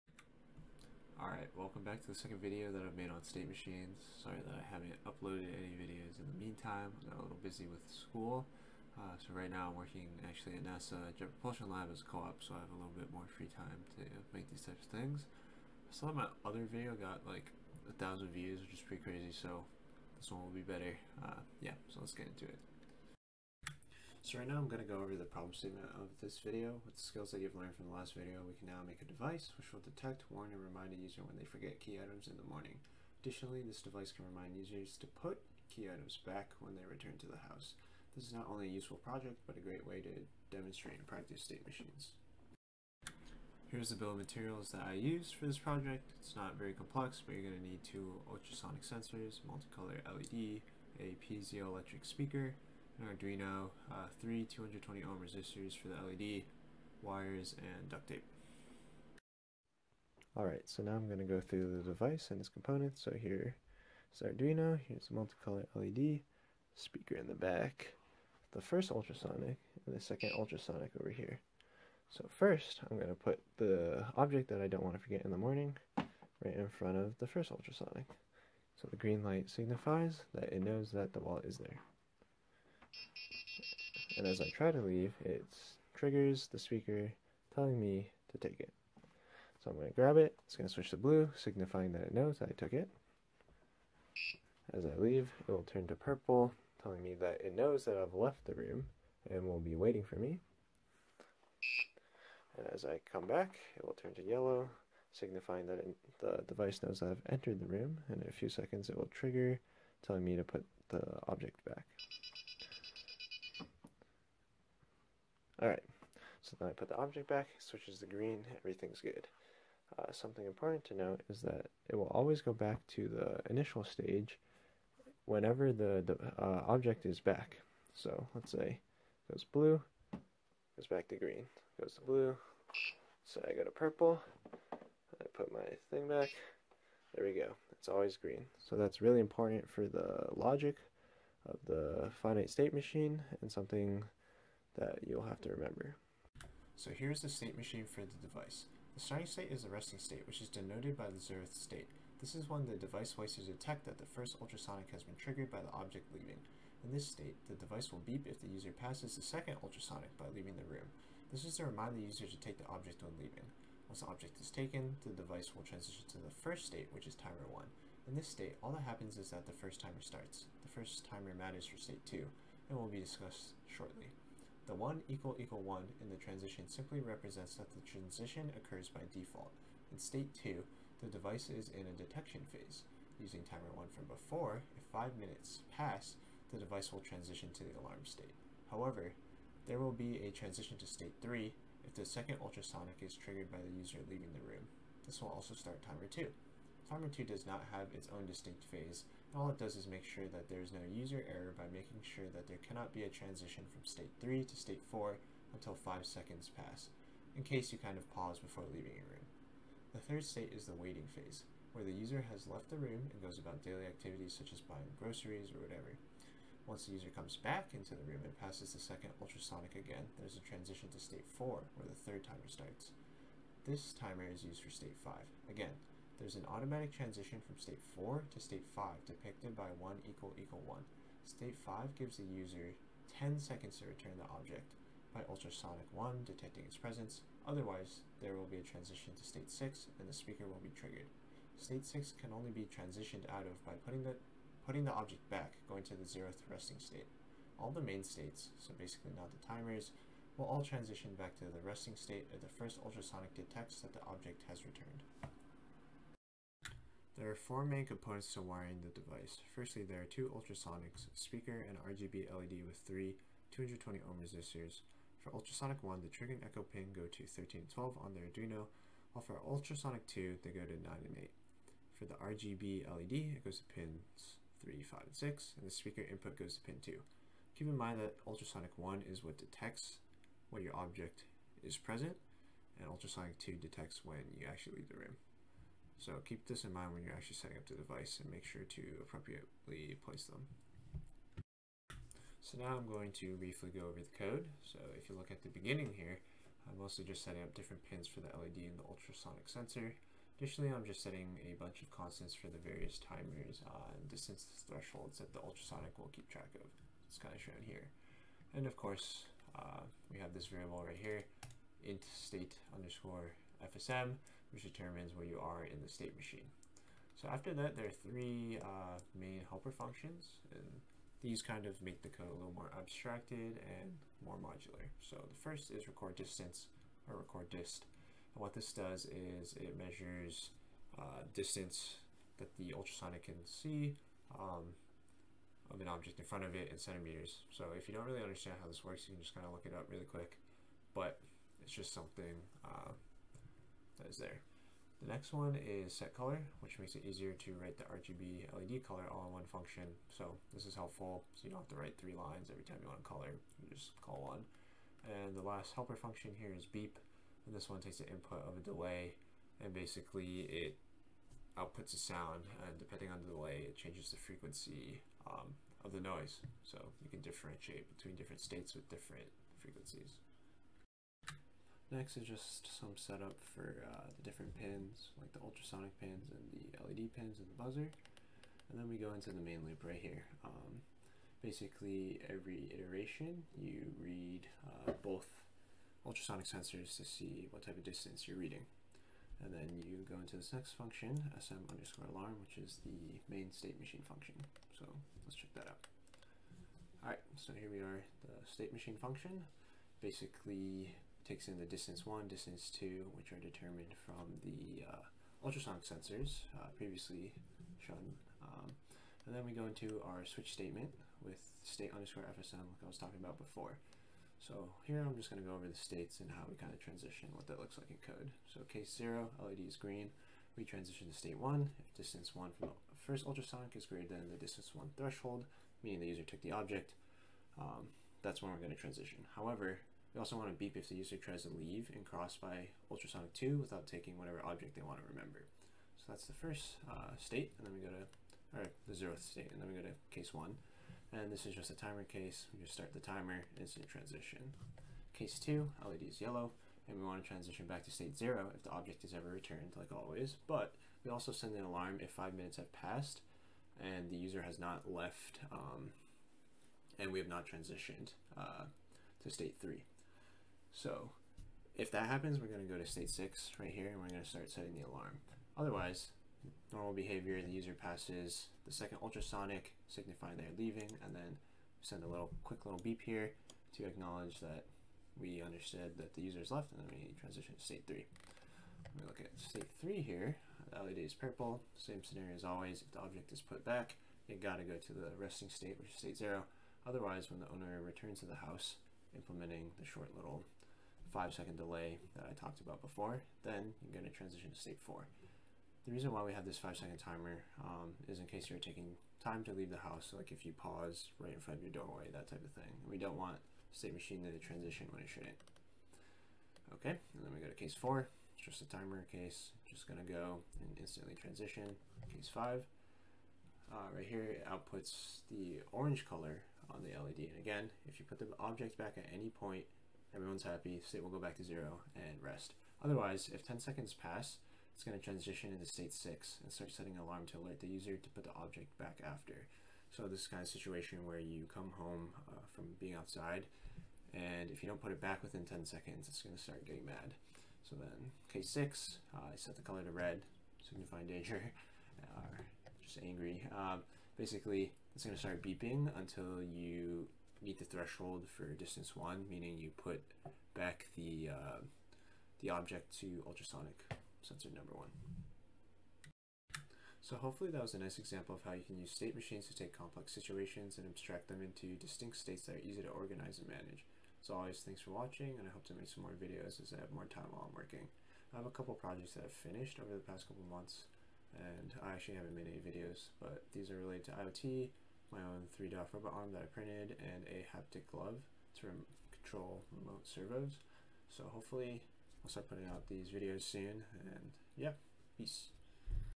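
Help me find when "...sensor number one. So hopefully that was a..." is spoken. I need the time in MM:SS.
09:14.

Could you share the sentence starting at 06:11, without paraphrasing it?
Next is just some setup for uh, the different pins, like the ultrasonic pins and the LED pins and the buzzer.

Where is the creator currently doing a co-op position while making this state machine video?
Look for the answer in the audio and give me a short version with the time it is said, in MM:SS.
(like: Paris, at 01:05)
NASA Jet Propulsion Lab, at 00:10.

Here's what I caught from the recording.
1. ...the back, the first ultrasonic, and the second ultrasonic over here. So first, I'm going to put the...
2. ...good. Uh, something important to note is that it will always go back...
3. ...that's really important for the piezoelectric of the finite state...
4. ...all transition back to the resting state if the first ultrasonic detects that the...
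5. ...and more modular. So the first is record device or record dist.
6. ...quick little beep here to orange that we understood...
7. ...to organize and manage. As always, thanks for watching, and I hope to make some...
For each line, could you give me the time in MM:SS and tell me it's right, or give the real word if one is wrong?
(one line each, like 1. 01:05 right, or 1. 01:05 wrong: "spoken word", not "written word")
1. 01:07 right
2. 01:58 right
3. 02:18 wrong: "logic", not "piezoelectric"
4. 04:10 right
5. 05:23 wrong: "distance", not "device"
6. 07:52 wrong: "acknowledge", not "orange"
7. 09:22 right.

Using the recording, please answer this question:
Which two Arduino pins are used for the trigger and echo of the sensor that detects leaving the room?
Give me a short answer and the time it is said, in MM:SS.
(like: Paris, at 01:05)
9 and 8, at 04:30.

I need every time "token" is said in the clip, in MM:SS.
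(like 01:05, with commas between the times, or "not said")
not said.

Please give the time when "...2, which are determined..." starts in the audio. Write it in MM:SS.
06:42.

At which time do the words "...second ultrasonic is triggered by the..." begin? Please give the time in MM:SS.
03:12.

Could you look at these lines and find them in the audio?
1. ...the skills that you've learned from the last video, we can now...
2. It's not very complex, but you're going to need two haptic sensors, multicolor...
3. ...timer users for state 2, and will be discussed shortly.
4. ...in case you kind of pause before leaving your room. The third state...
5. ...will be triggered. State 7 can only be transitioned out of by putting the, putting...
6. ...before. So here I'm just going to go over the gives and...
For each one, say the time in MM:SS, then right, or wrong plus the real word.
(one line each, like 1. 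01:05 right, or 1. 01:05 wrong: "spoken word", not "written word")
1. 00:26 right
2. 00:46 wrong: "ultrasonic", not "haptic"
3. 02:51 wrong: "matters", not "users"
4. 03:27 right
5. 04:00 wrong: "6", not "7"
6. 06:53 wrong: "states", not "gives".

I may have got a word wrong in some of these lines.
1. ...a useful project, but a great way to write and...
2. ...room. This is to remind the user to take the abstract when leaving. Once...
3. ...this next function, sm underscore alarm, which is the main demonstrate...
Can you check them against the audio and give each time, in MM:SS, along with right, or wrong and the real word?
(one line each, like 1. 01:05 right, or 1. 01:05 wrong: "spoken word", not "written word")
1. 00:38 wrong: "demonstrate", not "write"
2. 02:40 wrong: "object", not "abstract"
3. 06:30 wrong: "state", not "demonstrate".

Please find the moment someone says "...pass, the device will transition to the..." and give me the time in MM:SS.
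03:05.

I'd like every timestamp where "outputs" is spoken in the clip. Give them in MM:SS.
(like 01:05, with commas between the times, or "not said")
06:01, 08:34.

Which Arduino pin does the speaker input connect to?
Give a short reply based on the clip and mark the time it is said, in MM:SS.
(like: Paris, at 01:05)
Pin 2, at 04:36.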